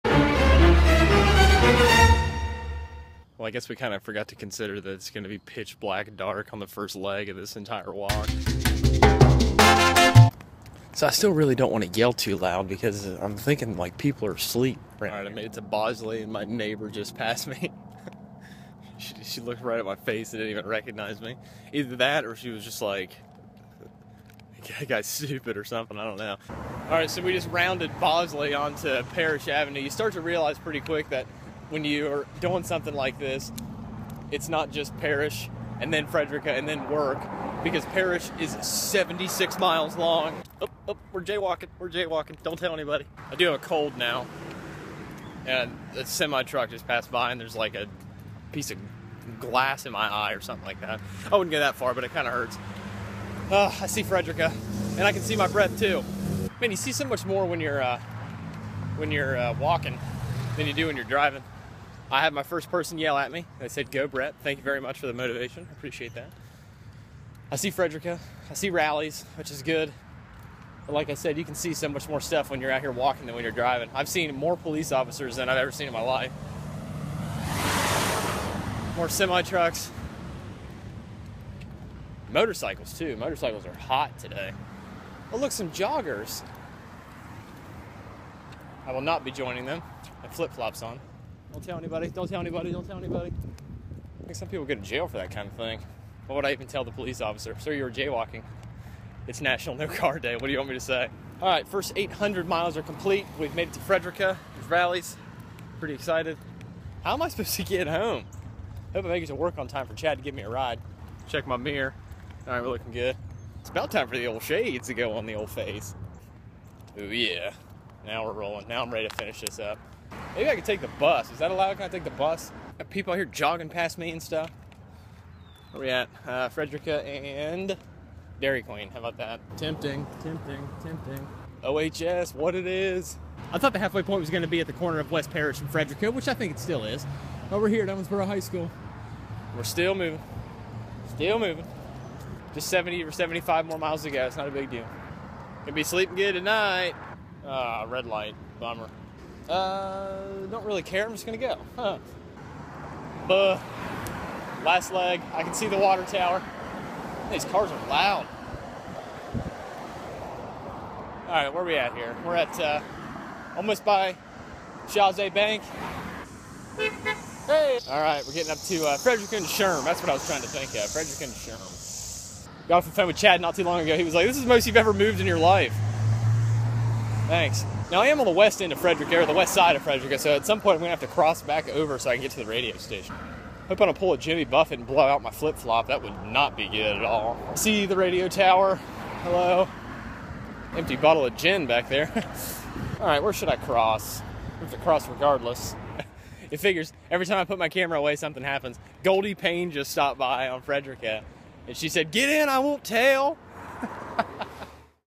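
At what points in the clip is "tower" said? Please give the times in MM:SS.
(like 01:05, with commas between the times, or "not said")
02:36, 03:08.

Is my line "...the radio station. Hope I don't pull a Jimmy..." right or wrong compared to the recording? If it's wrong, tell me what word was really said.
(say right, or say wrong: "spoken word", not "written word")
right.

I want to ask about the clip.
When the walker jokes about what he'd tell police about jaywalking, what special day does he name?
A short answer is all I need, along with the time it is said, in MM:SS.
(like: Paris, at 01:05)
National No Car Day, at 01:39.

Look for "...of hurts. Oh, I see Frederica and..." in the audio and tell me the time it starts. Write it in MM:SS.
00:52.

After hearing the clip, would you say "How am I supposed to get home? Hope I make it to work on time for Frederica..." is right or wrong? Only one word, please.
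wrong.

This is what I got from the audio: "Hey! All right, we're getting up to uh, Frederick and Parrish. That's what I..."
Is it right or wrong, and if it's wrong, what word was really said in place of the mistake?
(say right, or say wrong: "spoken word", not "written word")
wrong: "Sherm", not "Parrish".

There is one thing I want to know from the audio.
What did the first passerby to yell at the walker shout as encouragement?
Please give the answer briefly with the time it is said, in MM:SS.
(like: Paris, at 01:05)
Go, Brett, at 01:03.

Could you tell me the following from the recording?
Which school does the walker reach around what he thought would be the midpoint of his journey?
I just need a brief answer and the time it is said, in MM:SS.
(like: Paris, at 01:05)
Owensboro High School, at 02:17.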